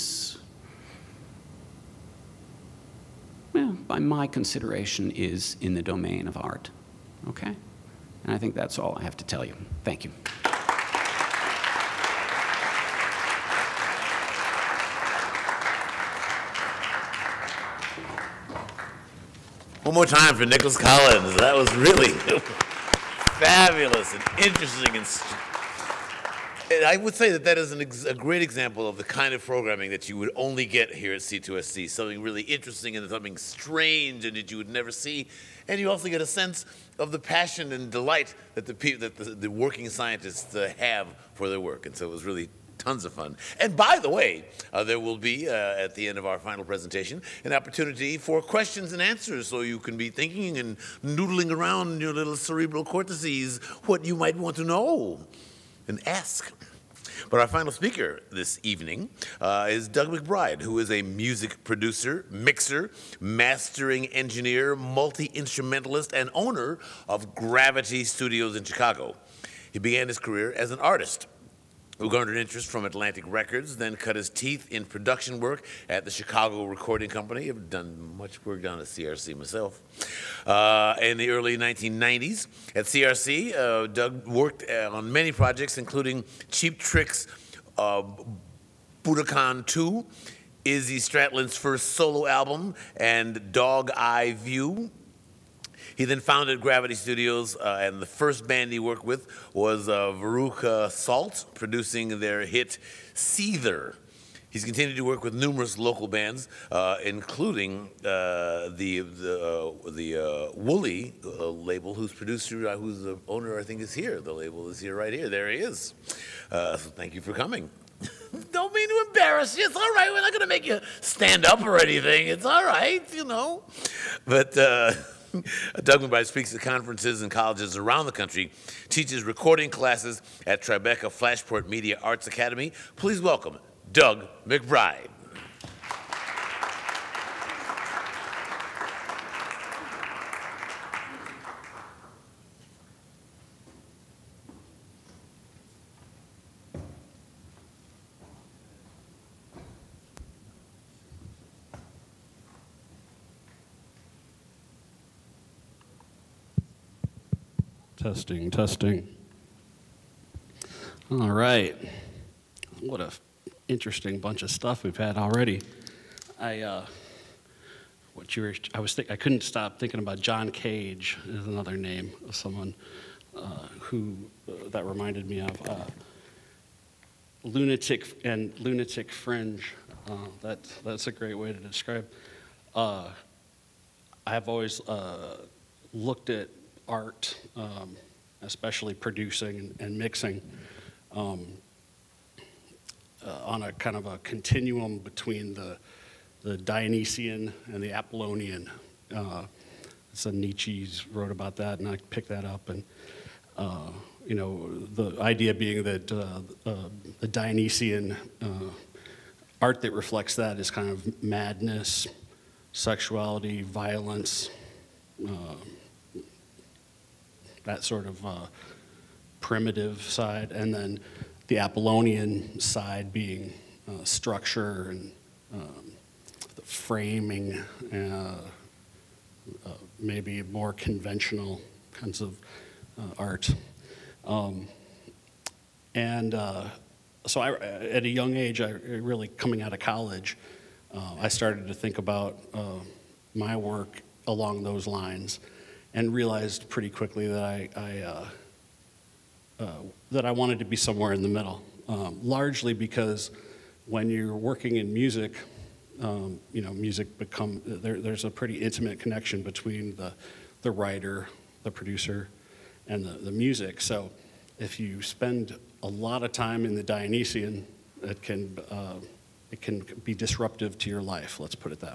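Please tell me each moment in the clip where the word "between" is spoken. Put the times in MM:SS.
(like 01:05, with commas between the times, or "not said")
03:14, 04:19.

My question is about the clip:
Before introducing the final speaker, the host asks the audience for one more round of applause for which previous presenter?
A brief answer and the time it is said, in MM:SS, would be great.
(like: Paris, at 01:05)
Nicolas Collins, at 00:20.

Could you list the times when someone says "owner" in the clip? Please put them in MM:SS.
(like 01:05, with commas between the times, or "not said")
01:06, 01:53.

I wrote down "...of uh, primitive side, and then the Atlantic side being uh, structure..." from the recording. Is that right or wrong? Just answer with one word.
wrong.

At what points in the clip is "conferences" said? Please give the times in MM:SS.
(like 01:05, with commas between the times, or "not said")
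02:06.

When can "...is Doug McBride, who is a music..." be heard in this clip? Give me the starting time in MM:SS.
00:59.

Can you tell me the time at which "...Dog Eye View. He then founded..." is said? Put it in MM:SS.
01:33.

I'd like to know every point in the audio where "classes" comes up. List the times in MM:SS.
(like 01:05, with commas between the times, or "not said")
02:09.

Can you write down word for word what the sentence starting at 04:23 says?
So if you spend a lot of time in the Dionysian, it can uh, it can be disruptive to your life.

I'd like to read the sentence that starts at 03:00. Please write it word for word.
Uh, that that's a great way to describe.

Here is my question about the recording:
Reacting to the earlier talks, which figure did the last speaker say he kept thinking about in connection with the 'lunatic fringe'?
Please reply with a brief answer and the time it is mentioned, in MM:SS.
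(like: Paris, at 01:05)
John Cage, at 02:50.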